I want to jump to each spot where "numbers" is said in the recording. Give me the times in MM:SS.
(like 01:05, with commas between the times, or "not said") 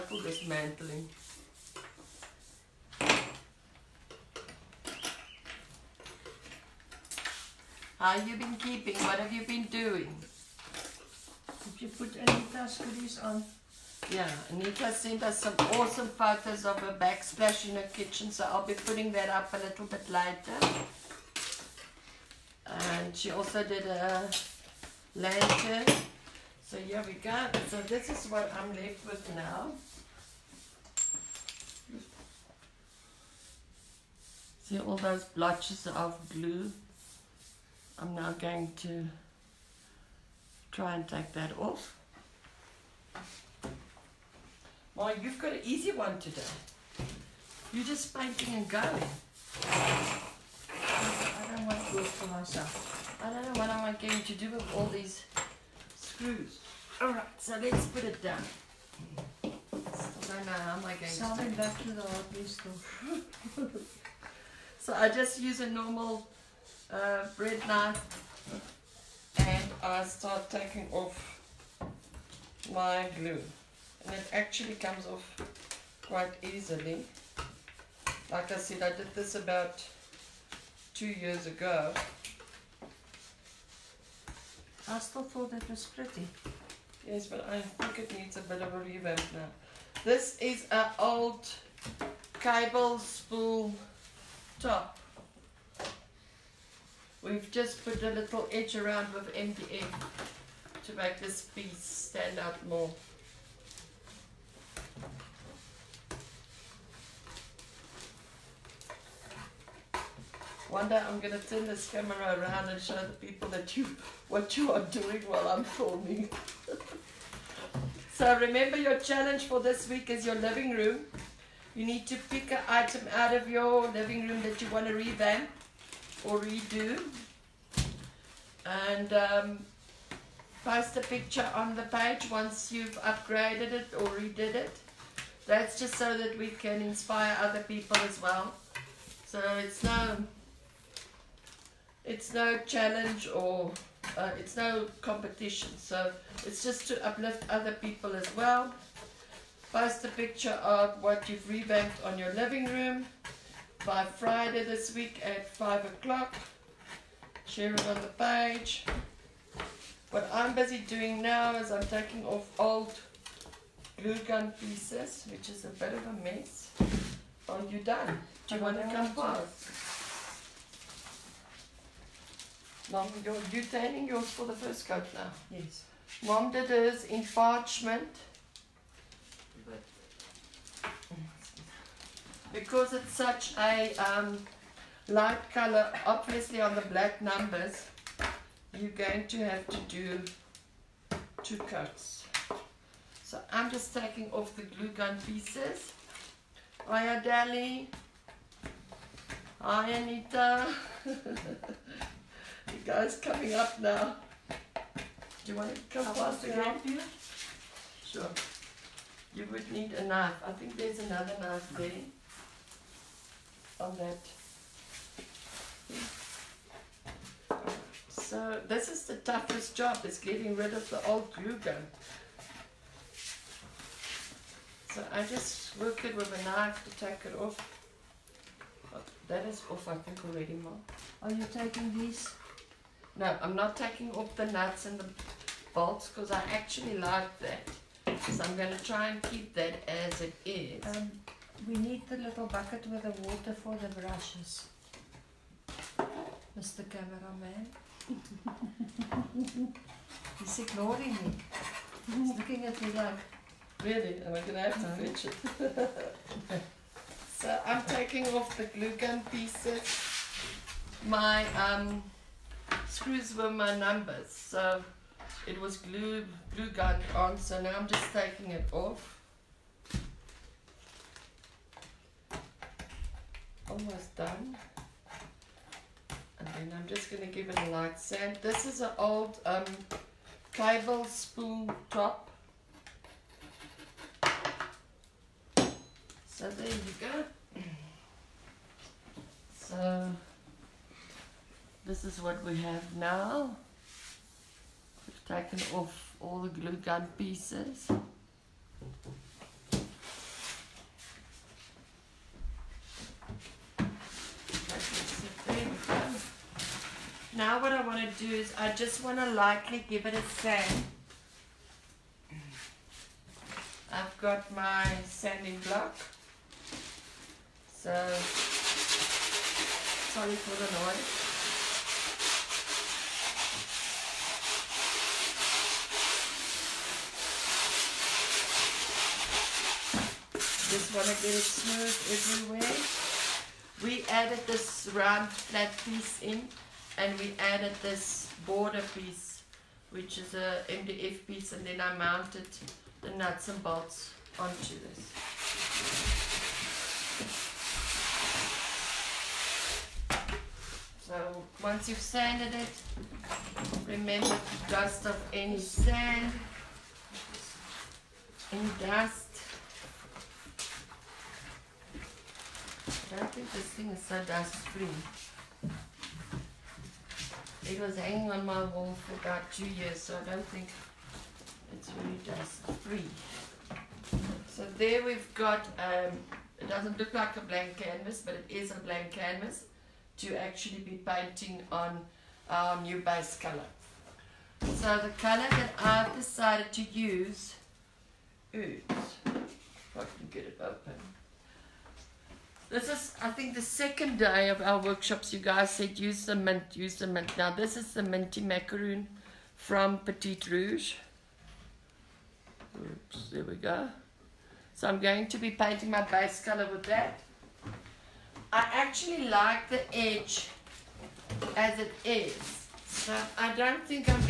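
03:07, 04:23.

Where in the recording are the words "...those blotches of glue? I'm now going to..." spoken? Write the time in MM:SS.
00:34.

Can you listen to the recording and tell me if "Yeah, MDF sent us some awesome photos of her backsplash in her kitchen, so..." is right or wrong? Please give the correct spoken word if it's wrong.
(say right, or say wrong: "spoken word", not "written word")
wrong: "Anita", not "MDF".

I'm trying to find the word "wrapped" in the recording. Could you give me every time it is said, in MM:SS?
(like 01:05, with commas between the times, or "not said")
not said.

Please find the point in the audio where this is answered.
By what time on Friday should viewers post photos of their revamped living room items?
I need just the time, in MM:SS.
02:35.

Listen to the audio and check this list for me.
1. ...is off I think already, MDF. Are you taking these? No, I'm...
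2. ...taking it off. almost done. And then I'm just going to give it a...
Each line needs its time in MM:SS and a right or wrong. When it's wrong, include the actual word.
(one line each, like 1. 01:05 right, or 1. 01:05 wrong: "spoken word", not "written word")
1. 03:49 wrong: "Mom", not "MDF"
2. 04:28 right.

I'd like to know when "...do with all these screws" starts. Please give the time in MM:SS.
00:54.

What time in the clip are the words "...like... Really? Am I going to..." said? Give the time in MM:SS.
04:12.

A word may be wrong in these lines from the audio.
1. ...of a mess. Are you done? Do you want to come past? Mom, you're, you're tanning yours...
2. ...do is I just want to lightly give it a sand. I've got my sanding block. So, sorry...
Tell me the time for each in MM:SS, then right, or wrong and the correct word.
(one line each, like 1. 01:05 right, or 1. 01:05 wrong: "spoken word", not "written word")
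1. 02:45 right
2. 05:08 right.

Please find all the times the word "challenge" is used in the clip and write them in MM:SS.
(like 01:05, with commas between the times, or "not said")
01:58, 02:22.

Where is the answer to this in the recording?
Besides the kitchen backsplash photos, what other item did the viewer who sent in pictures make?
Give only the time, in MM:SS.
00:23.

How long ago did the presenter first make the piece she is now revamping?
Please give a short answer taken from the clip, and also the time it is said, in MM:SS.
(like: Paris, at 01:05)
2 years ago, at 01:20.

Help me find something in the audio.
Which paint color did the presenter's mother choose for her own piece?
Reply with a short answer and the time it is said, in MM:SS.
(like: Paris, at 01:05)
Parchment, at 02:57.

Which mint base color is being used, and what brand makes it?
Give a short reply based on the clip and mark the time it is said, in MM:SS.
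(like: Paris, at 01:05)
Minty macaroon from Petit Rouge, at 06:38.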